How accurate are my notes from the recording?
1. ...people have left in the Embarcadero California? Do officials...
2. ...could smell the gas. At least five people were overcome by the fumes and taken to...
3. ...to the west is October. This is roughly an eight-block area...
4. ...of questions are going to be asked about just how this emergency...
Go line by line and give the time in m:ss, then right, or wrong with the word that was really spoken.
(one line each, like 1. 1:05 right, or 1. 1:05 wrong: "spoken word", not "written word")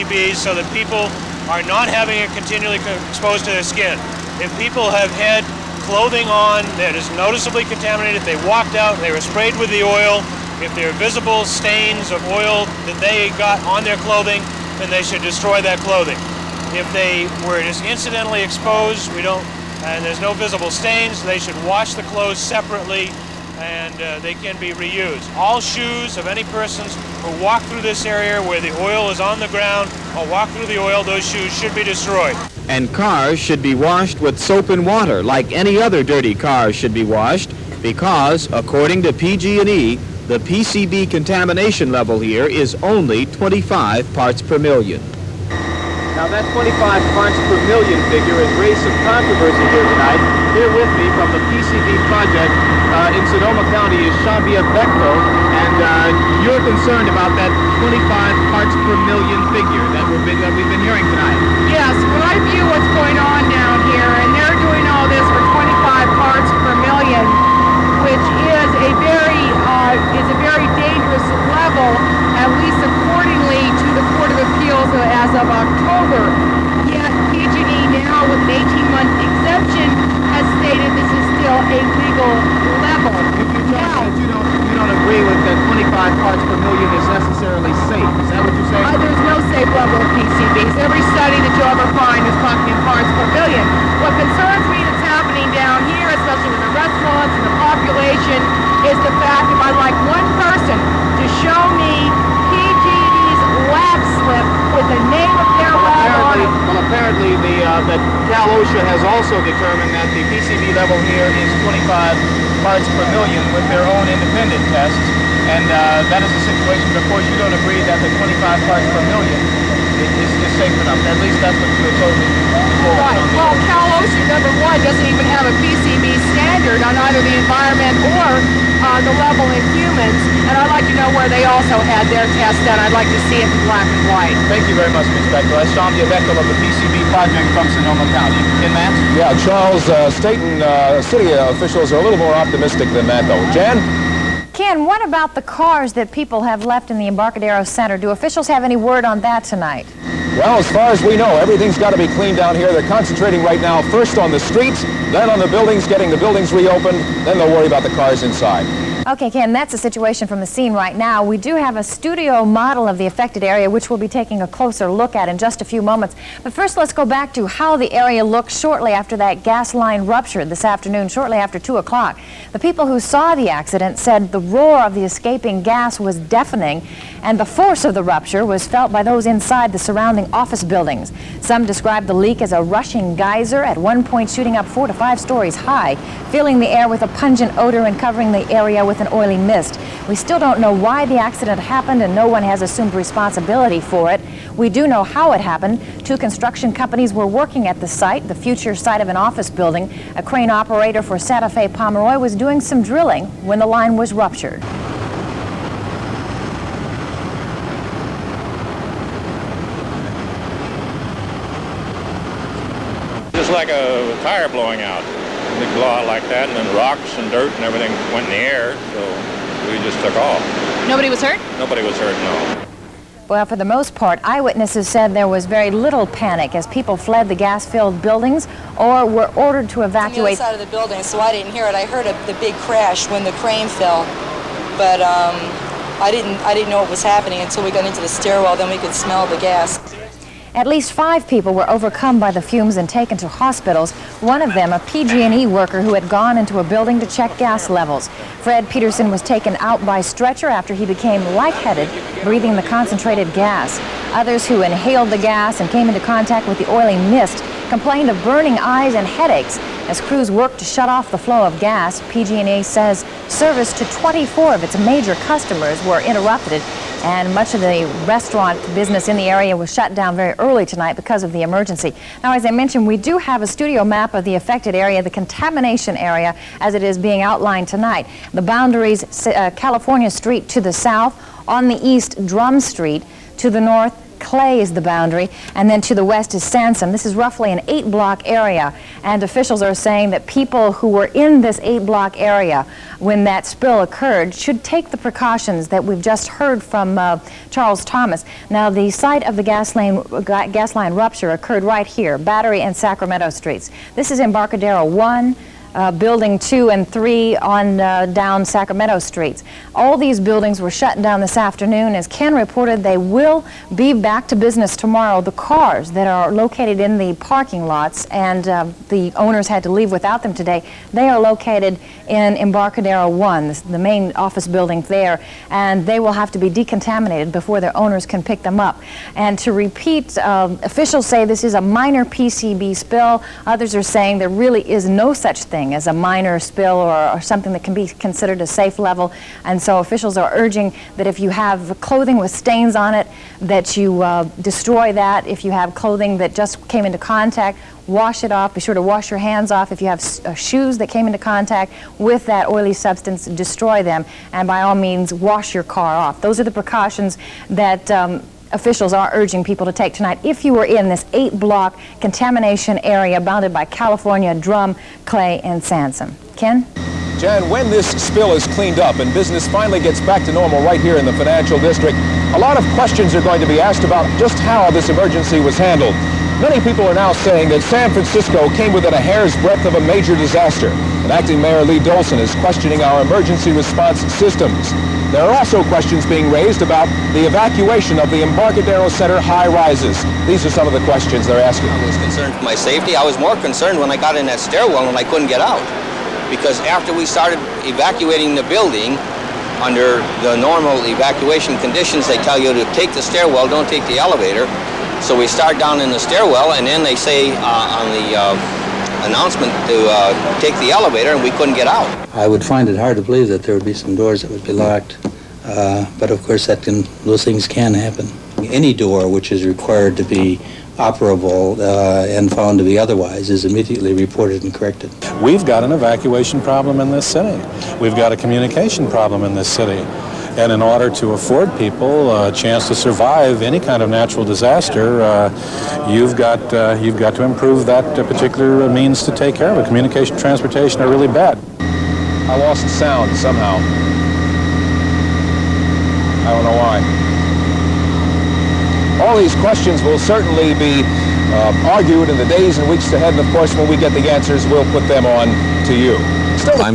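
1. 2:26 wrong: "Center", not "California"
2. 3:58 right
3. 4:45 wrong: "Sansome", not "October"
4. 6:12 right.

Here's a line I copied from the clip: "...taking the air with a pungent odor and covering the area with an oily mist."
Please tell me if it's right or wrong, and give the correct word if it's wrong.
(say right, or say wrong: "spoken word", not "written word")
wrong: "filling", not "taking".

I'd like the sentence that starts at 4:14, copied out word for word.
Others who inhaled the gas and came into contact with the oily mist complained of burning eyes and headaches.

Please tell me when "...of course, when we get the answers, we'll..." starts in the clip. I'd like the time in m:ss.
7:33.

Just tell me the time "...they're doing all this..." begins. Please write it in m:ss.
1:04.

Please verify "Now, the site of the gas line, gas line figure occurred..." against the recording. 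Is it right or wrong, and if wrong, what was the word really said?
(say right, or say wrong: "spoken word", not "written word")
wrong: "rupture", not "figure".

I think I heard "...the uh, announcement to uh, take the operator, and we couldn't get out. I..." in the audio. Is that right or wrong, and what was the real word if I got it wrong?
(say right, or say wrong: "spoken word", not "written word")
wrong: "elevator", not "operator".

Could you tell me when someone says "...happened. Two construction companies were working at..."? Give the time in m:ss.
3:15.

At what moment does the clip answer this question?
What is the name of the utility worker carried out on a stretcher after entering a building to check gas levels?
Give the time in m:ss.
4:08.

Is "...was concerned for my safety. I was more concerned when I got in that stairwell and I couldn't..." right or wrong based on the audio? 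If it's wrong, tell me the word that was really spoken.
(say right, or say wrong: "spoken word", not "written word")
right.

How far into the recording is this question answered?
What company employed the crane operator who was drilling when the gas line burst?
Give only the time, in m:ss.
3:21.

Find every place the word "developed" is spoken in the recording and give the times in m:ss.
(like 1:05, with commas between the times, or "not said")
not said.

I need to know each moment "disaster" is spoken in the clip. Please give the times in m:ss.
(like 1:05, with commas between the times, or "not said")
6:20, 7:14.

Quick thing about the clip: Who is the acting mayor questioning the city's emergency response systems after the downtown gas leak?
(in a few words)
Lee Dolson.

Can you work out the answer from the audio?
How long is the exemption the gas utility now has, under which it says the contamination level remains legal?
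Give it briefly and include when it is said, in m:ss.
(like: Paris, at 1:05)
18 months, at 1:18.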